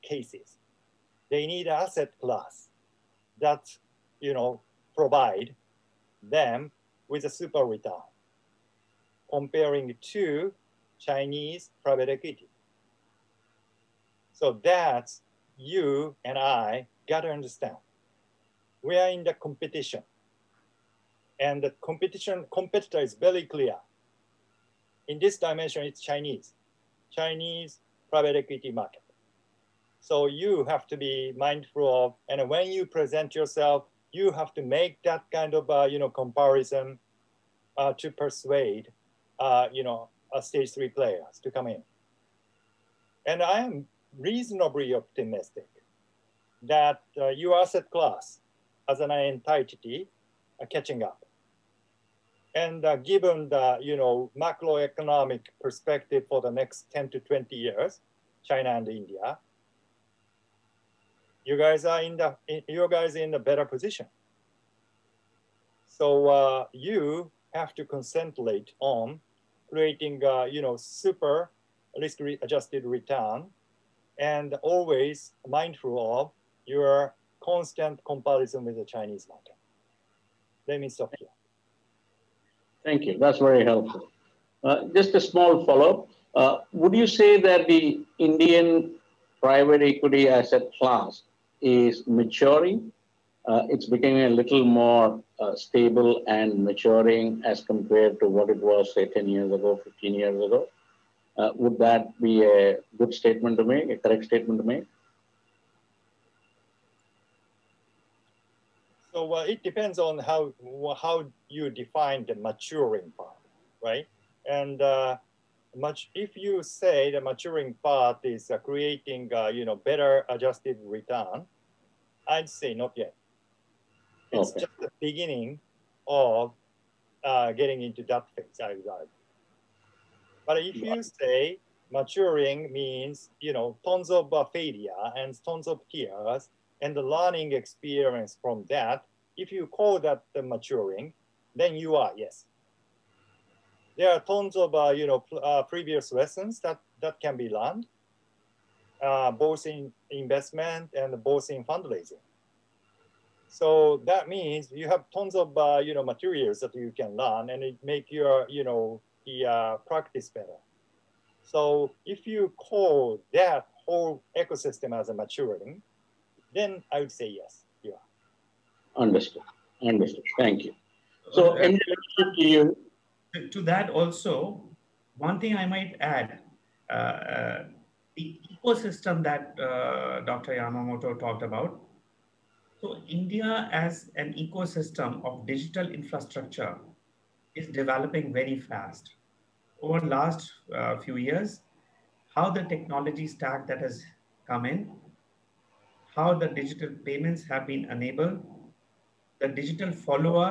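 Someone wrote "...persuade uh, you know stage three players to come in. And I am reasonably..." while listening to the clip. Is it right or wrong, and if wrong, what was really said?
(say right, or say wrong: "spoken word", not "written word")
right.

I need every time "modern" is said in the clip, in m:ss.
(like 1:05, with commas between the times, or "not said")
not said.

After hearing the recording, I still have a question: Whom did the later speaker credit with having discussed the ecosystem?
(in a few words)
Dr. Yamamoto.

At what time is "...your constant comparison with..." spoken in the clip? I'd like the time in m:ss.
1:16.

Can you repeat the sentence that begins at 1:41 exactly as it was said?
Uh, would that be a good statement to make, a correct statement to make?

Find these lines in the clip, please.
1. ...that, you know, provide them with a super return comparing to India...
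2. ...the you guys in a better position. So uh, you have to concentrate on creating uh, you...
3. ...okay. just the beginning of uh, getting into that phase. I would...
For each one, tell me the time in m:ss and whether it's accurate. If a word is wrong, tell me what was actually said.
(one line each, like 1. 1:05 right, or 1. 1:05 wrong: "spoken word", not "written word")
1. 0:03 wrong: "Chinese", not "India"
2. 1:02 right
3. 2:04 right.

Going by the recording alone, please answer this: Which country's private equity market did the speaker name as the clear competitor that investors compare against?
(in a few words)
China.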